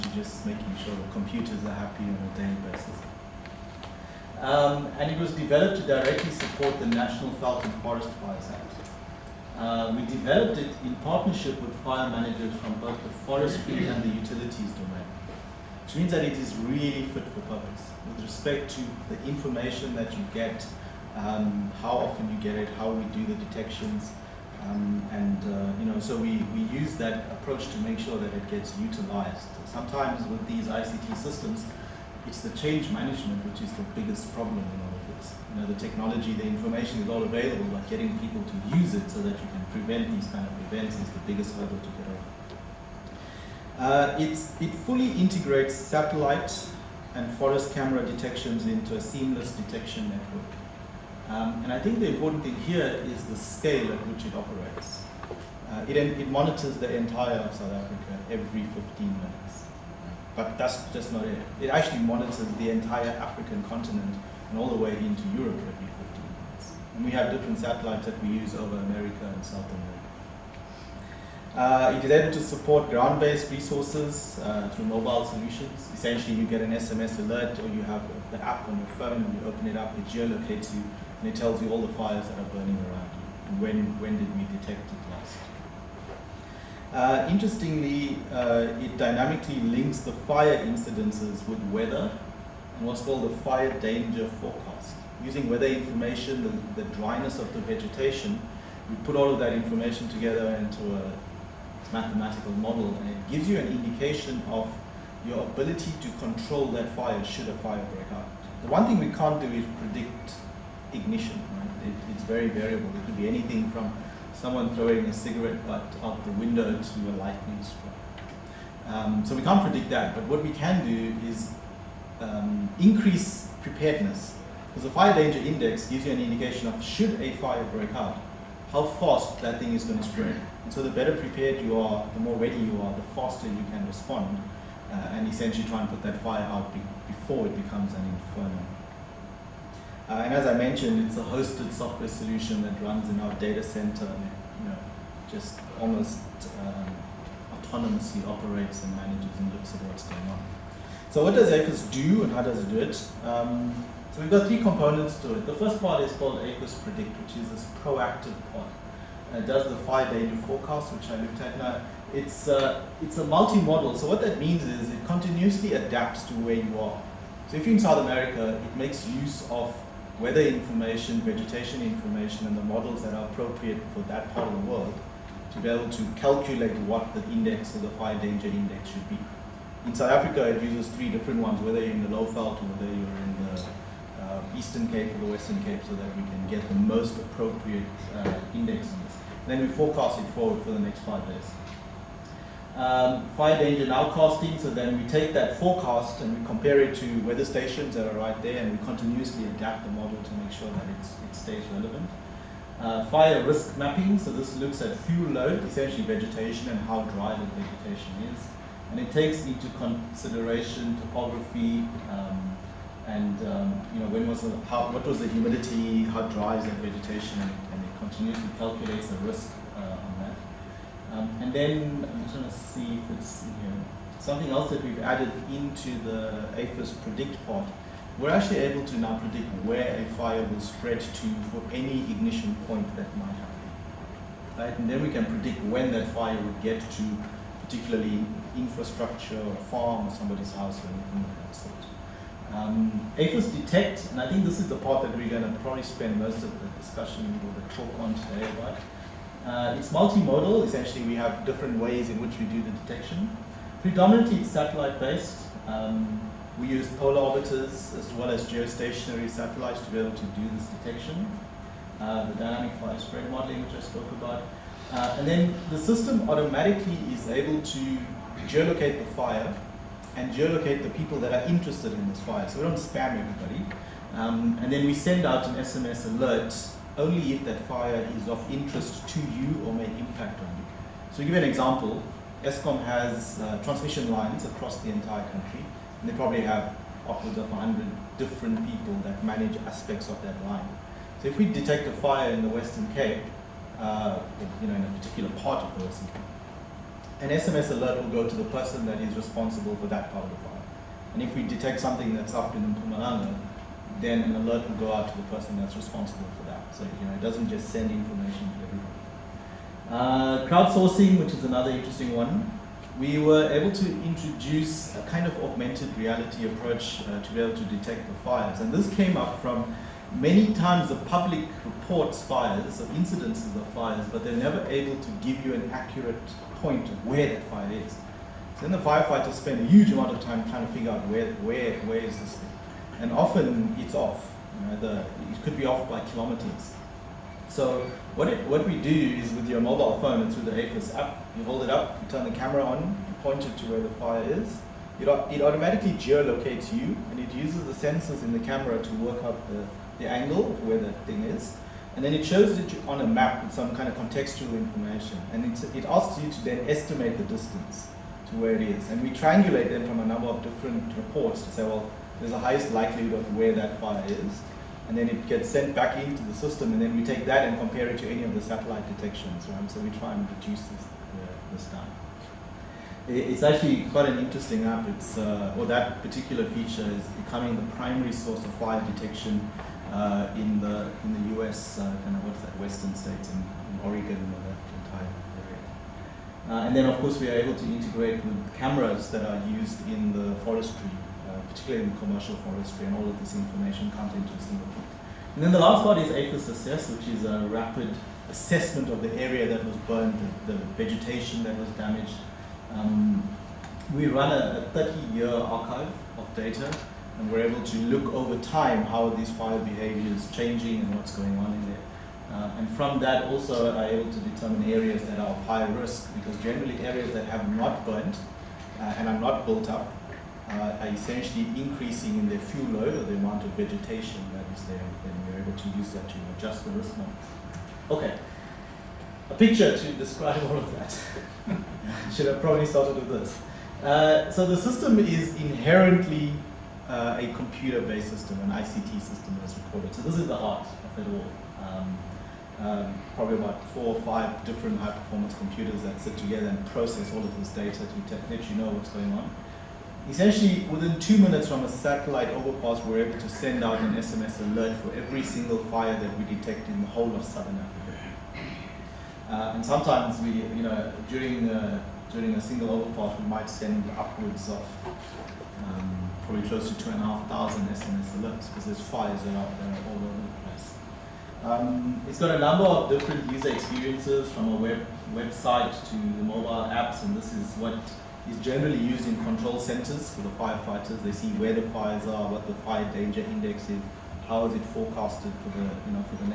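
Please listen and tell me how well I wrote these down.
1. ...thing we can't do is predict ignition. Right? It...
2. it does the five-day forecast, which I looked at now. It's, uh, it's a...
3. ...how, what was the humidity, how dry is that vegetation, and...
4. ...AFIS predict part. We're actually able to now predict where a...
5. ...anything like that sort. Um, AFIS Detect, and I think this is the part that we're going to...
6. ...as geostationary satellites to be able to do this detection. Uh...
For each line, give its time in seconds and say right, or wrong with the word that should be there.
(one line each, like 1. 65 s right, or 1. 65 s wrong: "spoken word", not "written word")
1. 108 s right
2. 159 s right
3. 214 s right
4. 226 s right
5. 240 s right
6. 258 s right.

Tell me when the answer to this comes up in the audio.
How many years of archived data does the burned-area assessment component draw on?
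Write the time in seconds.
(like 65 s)
404 s.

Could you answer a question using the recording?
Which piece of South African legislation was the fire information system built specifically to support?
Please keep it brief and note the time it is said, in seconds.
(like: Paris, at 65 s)
National Veld and Forest Fires Act, at 6 s.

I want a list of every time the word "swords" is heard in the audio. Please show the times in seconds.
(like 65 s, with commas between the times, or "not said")
not said.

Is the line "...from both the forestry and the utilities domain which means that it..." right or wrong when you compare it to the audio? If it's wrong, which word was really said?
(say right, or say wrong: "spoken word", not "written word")
right.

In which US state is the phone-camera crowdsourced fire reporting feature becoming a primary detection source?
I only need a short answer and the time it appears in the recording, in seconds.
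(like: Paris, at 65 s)
Oregon, at 383 s.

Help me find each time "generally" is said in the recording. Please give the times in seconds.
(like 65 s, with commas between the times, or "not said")
416 s, 478 s.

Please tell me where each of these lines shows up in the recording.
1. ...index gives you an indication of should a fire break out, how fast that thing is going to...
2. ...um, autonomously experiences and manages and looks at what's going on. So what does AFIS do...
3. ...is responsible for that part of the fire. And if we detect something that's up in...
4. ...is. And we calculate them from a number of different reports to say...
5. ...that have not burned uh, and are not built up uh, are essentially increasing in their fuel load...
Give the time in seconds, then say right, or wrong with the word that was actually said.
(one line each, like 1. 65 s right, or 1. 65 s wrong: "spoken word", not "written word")
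1. 125 s right
2. 146 s wrong: "operates", not "experiences"
3. 299 s right
4. 358 s wrong: "triangulate", not "calculate"
5. 417 s right.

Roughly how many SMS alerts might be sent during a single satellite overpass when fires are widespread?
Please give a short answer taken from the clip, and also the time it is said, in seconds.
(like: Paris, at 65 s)
2,500, at 466 s.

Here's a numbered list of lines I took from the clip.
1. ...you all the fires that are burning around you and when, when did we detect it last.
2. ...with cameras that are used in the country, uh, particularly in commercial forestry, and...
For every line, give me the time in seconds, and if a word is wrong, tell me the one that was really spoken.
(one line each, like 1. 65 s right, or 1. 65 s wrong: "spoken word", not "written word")
1. 81 s right
2. 388 s wrong: "forestry", not "country".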